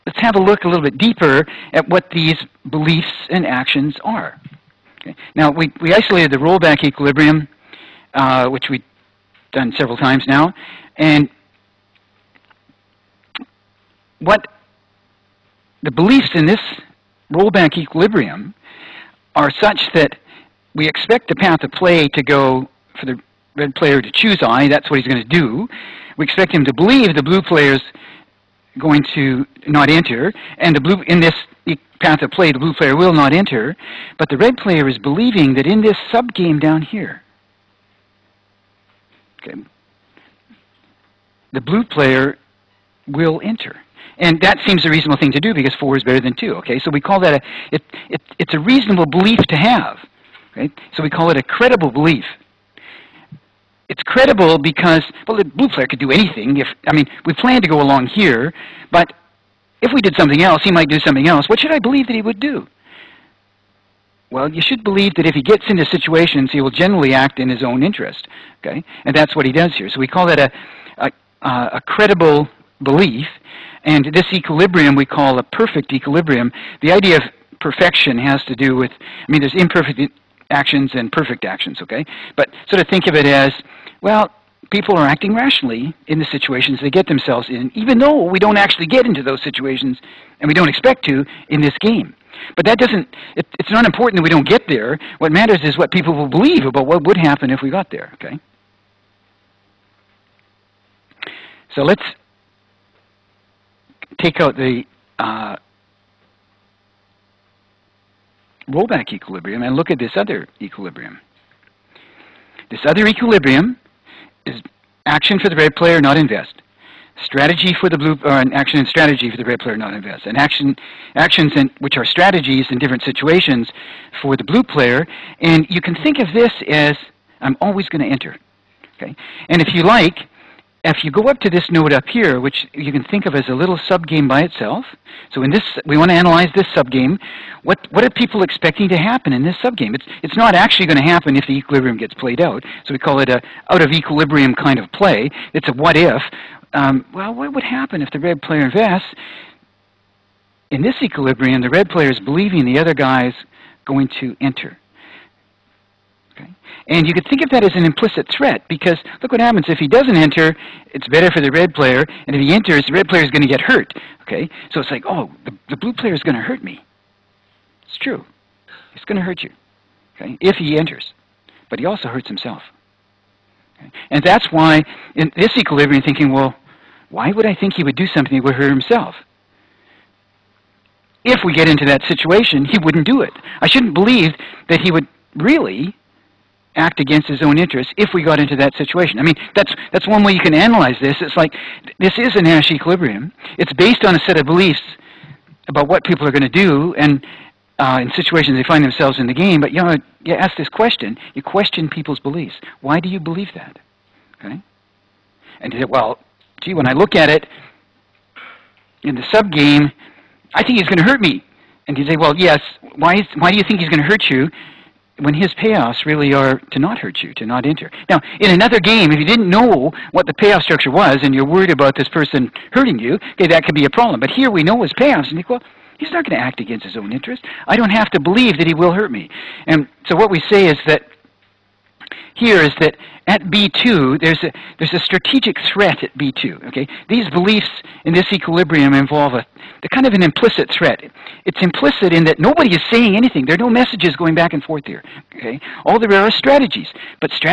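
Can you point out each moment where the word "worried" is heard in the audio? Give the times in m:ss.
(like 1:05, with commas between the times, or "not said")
3:41.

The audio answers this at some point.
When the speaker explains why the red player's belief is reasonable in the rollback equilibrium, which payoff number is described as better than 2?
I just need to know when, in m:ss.
0:45.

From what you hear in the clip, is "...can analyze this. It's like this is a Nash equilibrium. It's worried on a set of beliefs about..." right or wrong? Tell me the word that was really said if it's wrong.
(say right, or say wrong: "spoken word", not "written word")
wrong: "based", not "worried".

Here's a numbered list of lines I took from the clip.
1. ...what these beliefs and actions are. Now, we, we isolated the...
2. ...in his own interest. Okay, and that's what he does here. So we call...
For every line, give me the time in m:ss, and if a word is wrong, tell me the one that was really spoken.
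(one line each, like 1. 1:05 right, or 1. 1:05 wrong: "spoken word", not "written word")
1. 0:01 right
2. 1:07 right.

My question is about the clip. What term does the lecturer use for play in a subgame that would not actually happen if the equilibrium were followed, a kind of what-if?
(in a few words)
out-of-equilibrium.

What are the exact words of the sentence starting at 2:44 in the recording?
Okay, so it's like, oh, the, the blue player is going to hurt me.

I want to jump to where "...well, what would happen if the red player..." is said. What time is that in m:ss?
2:27.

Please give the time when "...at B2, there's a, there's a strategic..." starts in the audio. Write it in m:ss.
3:53.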